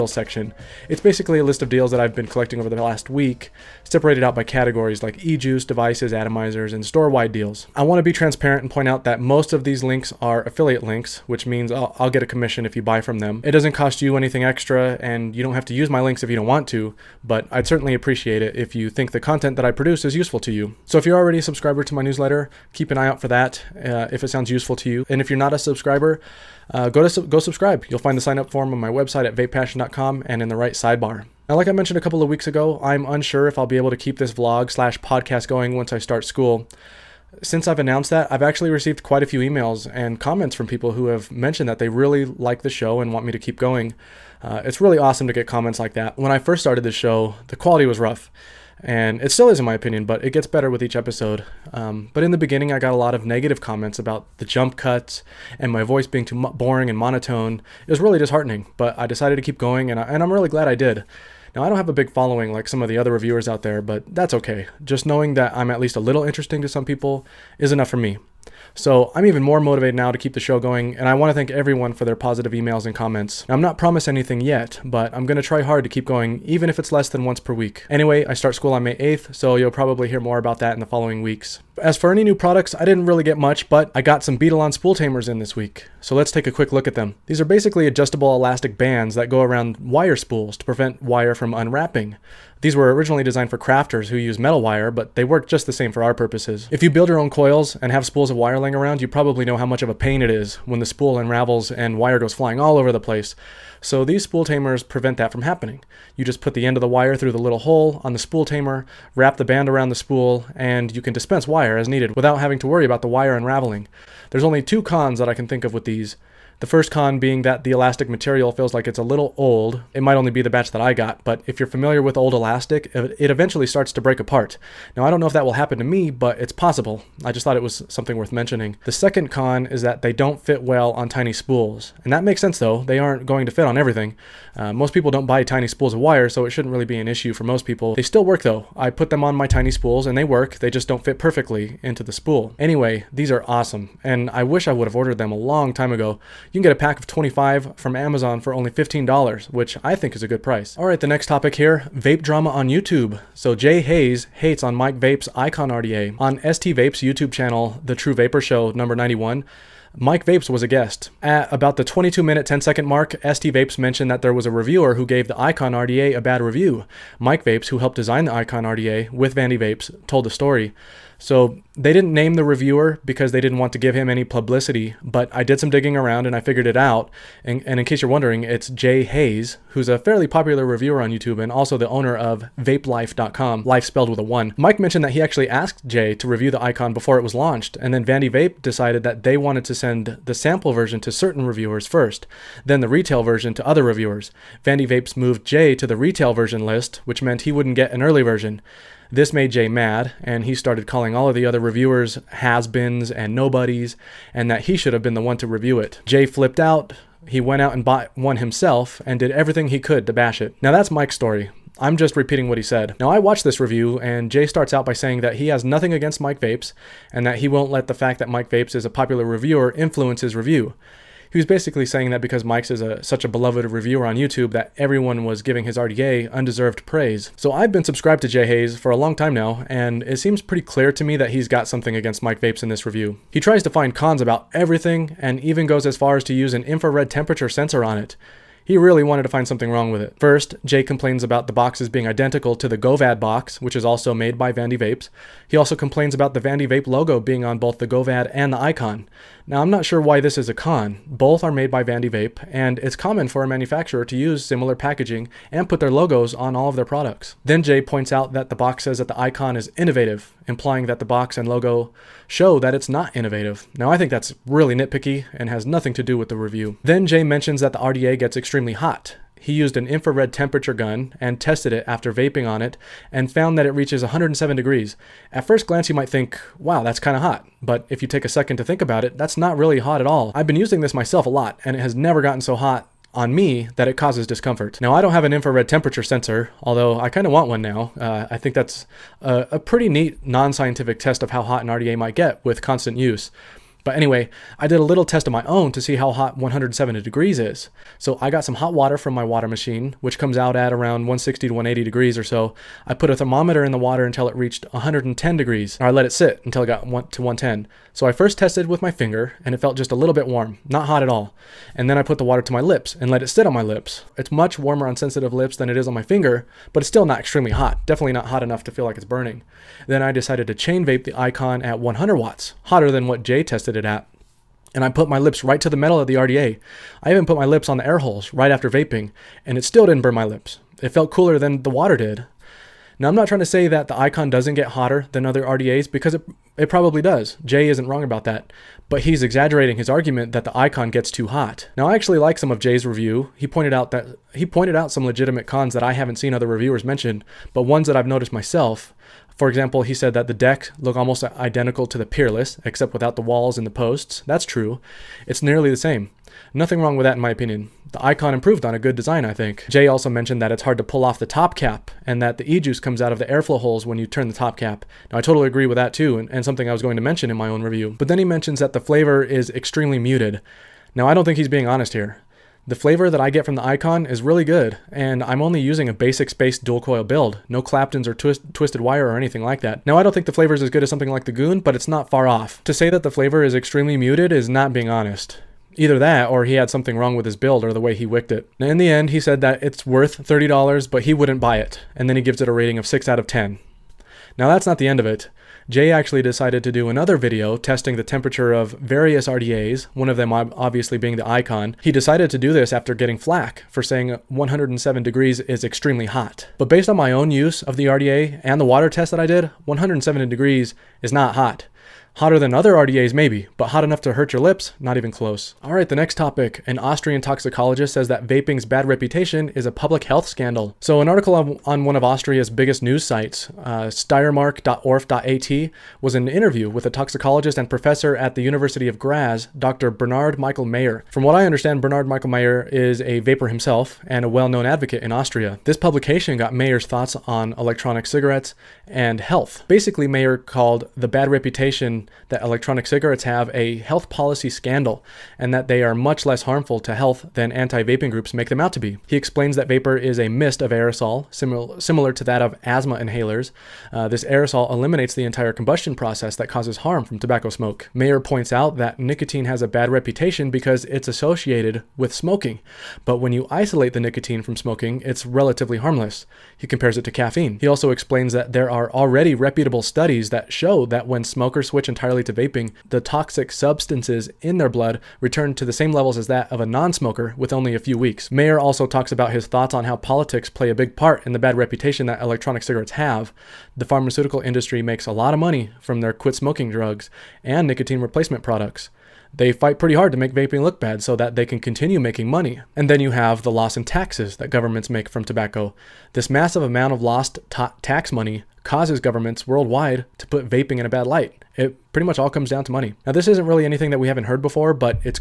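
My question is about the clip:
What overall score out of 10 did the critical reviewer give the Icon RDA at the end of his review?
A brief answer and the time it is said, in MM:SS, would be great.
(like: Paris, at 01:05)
6 out of 10, at 06:32.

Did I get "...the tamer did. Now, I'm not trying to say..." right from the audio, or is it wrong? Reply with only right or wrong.
wrong.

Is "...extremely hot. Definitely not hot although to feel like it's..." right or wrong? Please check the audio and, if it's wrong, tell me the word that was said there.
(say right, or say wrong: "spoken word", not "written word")
wrong: "enough", not "although".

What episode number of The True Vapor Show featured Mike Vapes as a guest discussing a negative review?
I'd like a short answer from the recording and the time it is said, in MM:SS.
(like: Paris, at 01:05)
91, at 02:38.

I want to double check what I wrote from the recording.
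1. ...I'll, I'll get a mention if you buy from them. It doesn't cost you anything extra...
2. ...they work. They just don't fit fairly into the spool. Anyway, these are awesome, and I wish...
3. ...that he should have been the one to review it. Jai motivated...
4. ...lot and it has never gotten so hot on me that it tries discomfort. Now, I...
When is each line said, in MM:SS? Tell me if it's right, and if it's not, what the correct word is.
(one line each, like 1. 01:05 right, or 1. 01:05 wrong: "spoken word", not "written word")
1. 00:11 wrong: "commission", not "mention"
2. 02:20 wrong: "perfectly", not "fairly"
3. 03:24 wrong: "flipped", not "motivated"
4. 04:41 wrong: "causes", not "tries".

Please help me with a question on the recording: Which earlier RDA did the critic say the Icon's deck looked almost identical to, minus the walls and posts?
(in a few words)
Peerless.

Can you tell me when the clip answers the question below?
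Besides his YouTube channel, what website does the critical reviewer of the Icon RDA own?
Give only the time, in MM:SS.
03:02.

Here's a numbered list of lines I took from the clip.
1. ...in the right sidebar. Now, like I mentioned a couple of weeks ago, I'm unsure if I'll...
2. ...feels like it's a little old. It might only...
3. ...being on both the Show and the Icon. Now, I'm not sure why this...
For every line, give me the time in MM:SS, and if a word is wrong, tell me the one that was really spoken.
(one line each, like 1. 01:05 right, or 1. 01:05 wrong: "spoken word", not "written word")
1. 00:30 right
2. 01:58 right
3. 04:07 wrong: "Govad", not "Show".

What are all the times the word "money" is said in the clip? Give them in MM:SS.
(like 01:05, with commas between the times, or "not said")
08:05, 08:12, 08:18, 08:22.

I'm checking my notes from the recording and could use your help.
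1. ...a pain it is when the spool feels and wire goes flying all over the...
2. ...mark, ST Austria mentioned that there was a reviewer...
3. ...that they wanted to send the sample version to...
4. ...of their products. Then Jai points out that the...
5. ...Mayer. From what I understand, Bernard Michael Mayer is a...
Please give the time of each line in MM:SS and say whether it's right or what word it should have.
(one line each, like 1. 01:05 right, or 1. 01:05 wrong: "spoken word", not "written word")
1. 01:39 wrong: "unravels", not "feels"
2. 02:42 wrong: "Vapes", not "Austria"
3. 03:09 right
4. 04:16 right
5. 07:10 right.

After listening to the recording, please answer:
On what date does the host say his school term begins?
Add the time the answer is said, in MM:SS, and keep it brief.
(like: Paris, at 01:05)
May 8th, at 01:18.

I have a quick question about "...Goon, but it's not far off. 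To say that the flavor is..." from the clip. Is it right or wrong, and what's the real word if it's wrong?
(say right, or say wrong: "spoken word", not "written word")
right.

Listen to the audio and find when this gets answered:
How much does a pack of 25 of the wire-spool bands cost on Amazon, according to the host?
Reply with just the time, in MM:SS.
02:28.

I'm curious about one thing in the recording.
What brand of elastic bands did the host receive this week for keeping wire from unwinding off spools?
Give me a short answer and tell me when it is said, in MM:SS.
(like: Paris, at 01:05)
Beadalon, at 01:24.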